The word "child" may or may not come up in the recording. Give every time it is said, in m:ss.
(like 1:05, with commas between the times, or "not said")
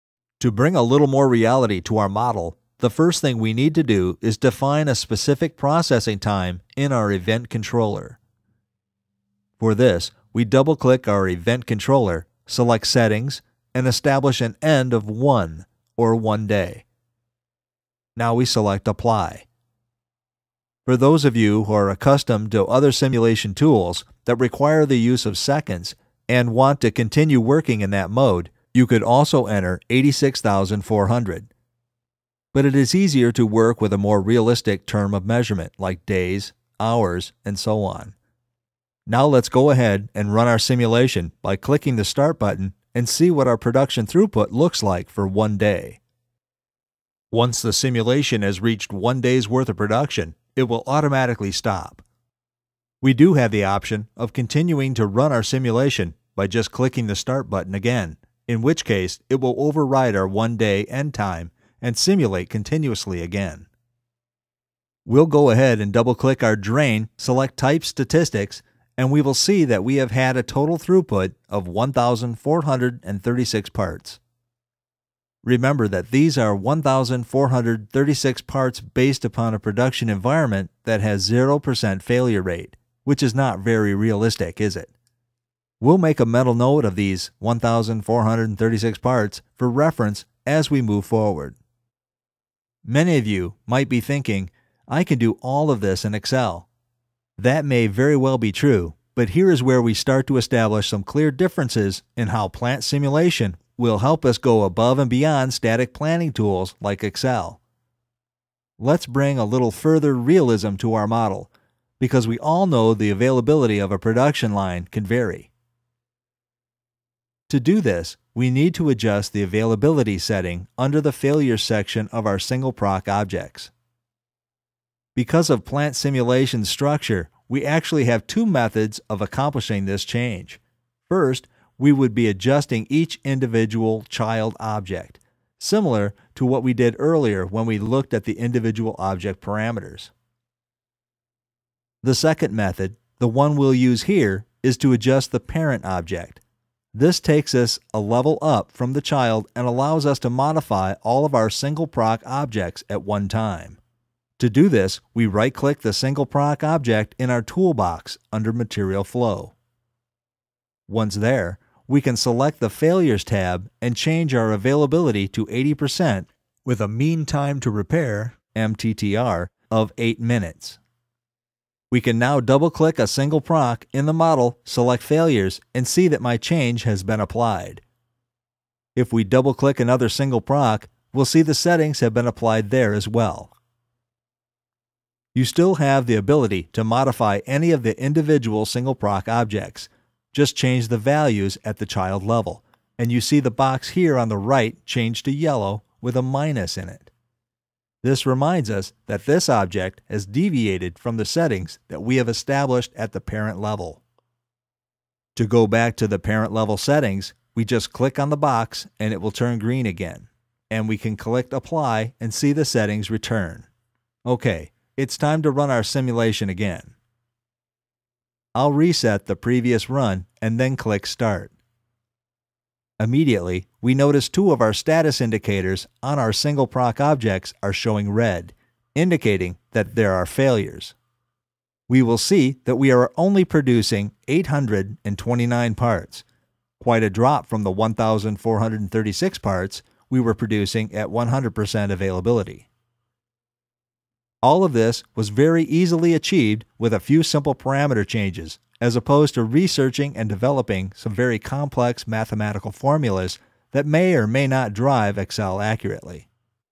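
2:14, 2:29, 3:11.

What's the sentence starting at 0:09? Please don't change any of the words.
For this, we double-click our event controller, select Settings, and establish an end of 1, or 1 day.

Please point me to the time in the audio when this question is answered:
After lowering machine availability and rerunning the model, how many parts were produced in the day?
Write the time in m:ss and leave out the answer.
3:54.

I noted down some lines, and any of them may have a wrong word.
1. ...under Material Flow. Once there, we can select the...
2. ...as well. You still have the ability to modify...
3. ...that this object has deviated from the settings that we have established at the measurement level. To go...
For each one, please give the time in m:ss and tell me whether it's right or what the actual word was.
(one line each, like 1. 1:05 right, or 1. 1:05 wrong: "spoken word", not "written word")
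1. 2:38 right
2. 3:02 right
3. 3:19 wrong: "parent", not "measurement".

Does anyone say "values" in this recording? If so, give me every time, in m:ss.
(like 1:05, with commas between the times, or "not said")
3:10.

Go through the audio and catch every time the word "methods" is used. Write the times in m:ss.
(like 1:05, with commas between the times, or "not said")
2:08, 2:22.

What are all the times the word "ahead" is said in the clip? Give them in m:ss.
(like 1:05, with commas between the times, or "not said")
0:39, 1:05.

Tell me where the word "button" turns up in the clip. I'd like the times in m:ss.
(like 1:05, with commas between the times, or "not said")
0:42, 0:57.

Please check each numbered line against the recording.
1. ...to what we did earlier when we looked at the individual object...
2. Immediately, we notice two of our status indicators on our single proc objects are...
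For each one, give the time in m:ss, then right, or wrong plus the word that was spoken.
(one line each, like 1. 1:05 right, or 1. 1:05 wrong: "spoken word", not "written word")
1. 2:16 right
2. 3:43 right.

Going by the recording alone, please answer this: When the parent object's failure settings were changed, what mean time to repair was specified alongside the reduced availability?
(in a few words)
8 minutes.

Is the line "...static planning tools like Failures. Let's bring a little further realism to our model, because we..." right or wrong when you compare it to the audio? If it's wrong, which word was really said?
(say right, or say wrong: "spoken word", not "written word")
wrong: "Excel", not "Failures".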